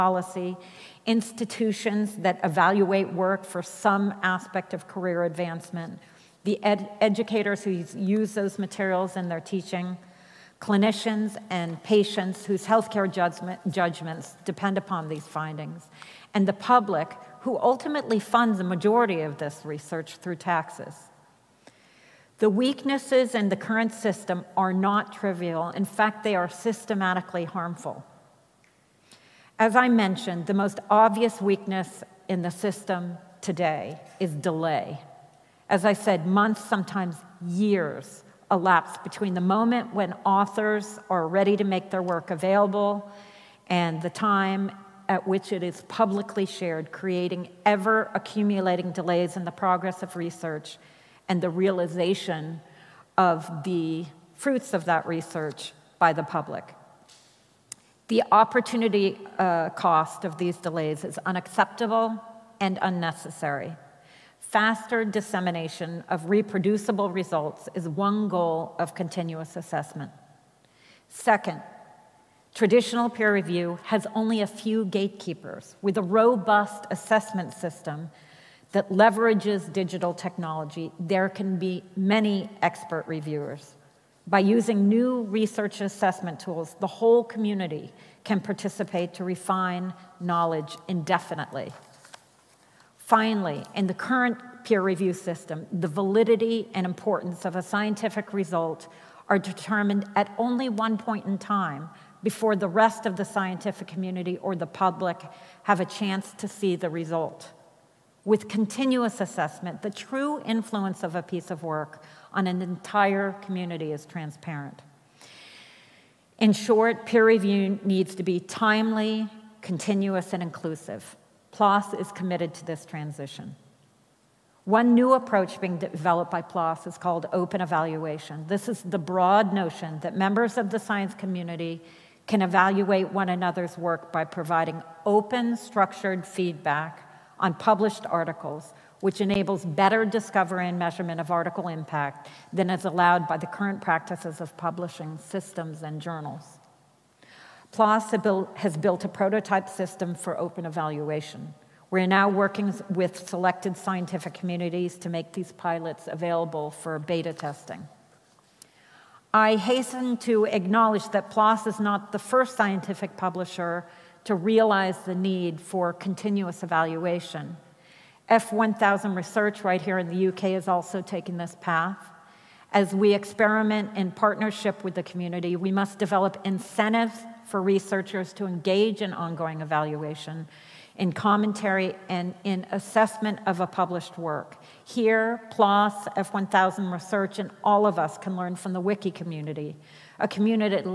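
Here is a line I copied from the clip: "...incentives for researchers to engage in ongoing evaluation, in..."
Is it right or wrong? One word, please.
right.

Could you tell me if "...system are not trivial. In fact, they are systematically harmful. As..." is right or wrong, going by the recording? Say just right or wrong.
right.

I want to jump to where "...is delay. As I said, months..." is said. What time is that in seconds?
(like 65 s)
34 s.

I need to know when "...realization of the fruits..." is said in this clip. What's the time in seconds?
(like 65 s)
51 s.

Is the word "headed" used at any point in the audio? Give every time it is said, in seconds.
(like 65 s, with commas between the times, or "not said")
not said.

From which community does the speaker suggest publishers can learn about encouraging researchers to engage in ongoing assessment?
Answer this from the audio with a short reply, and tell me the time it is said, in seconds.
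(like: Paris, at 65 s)
the wiki community, at 188 s.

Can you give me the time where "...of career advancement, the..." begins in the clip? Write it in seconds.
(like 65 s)
4 s.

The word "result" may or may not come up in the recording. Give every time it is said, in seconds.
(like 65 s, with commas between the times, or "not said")
67 s, 98 s, 106 s.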